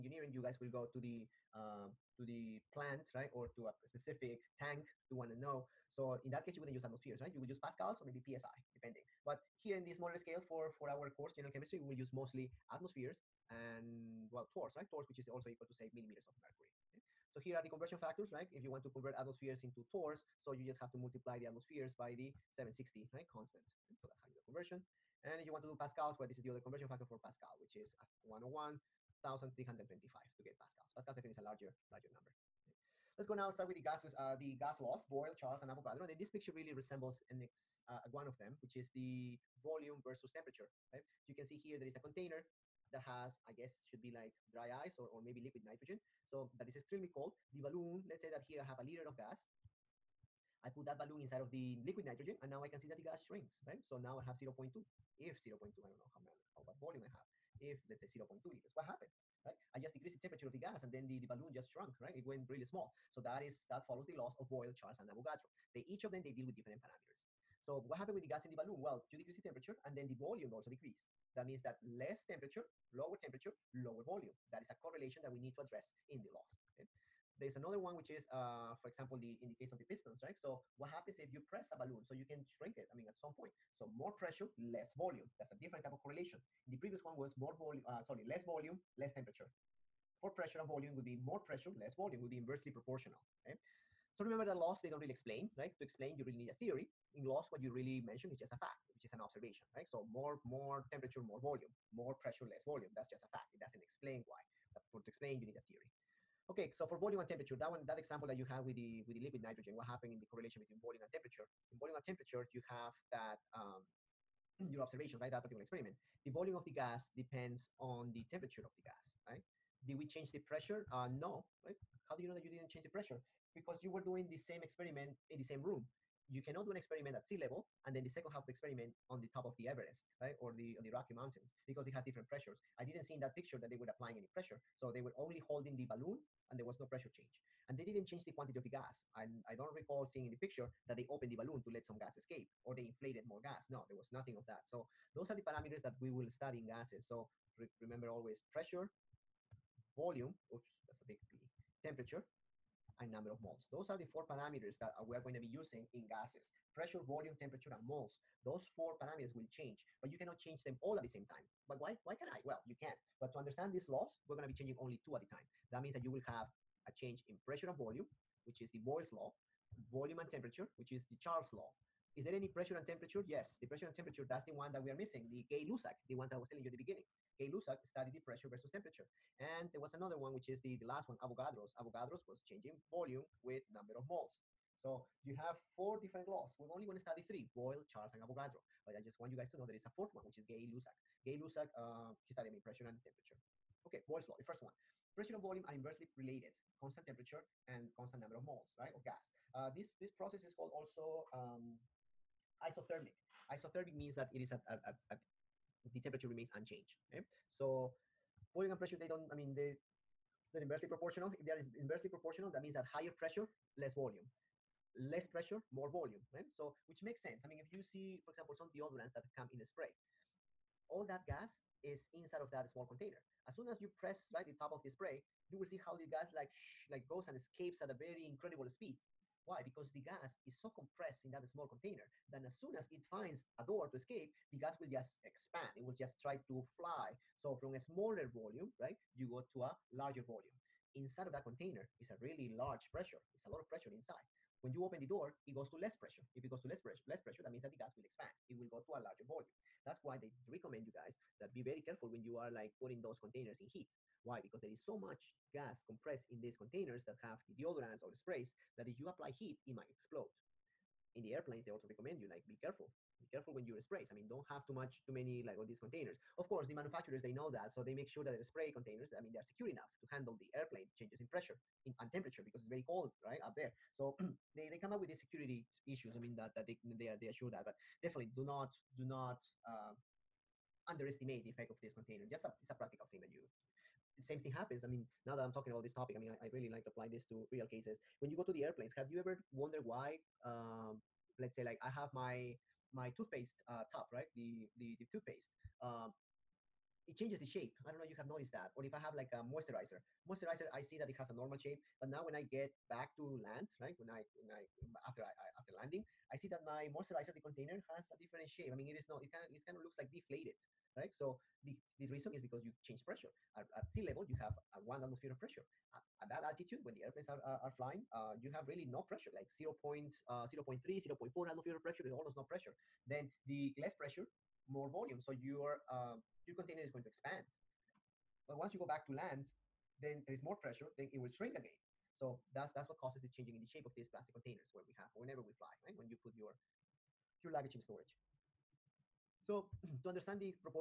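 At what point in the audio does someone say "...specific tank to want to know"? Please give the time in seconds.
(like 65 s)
3 s.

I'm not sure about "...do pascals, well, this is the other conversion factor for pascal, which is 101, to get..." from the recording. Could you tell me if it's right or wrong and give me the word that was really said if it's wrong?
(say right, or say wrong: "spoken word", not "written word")
right.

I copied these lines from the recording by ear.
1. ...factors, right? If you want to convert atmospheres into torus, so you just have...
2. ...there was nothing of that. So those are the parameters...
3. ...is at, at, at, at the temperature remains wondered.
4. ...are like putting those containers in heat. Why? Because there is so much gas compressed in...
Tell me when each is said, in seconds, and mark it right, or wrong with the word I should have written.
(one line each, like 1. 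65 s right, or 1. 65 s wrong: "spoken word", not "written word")
1. 17 s right
2. 143 s right
3. 204 s wrong: "unchanged", not "wondered"
4. 252 s right.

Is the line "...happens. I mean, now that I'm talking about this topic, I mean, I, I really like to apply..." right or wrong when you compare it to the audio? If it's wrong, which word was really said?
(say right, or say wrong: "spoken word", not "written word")
right.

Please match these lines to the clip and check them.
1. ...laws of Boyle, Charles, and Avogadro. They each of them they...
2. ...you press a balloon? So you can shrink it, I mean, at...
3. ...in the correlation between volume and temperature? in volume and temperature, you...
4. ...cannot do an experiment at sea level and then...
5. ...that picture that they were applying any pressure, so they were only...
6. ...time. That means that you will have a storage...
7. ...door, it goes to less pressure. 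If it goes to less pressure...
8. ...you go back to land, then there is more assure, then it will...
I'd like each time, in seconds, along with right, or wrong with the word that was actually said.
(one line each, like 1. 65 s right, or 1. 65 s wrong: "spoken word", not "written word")
1. 64 s right
2. 81 s right
3. 110 s right
4. 126 s right
5. 133 s right
6. 165 s wrong: "change", not "storage"
7. 245 s right
8. 328 s wrong: "pressure", not "assure".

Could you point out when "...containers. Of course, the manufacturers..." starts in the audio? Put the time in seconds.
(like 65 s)
265 s.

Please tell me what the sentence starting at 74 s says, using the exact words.
That is a correlation that we need to address in the laws.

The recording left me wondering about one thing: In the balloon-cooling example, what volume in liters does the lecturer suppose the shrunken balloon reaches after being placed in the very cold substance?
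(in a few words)
0.2 liters.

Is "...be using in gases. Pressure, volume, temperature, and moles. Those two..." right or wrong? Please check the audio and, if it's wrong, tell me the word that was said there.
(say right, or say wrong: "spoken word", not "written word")
wrong: "four", not "two".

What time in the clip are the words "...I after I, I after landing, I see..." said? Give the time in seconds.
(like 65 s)
304 s.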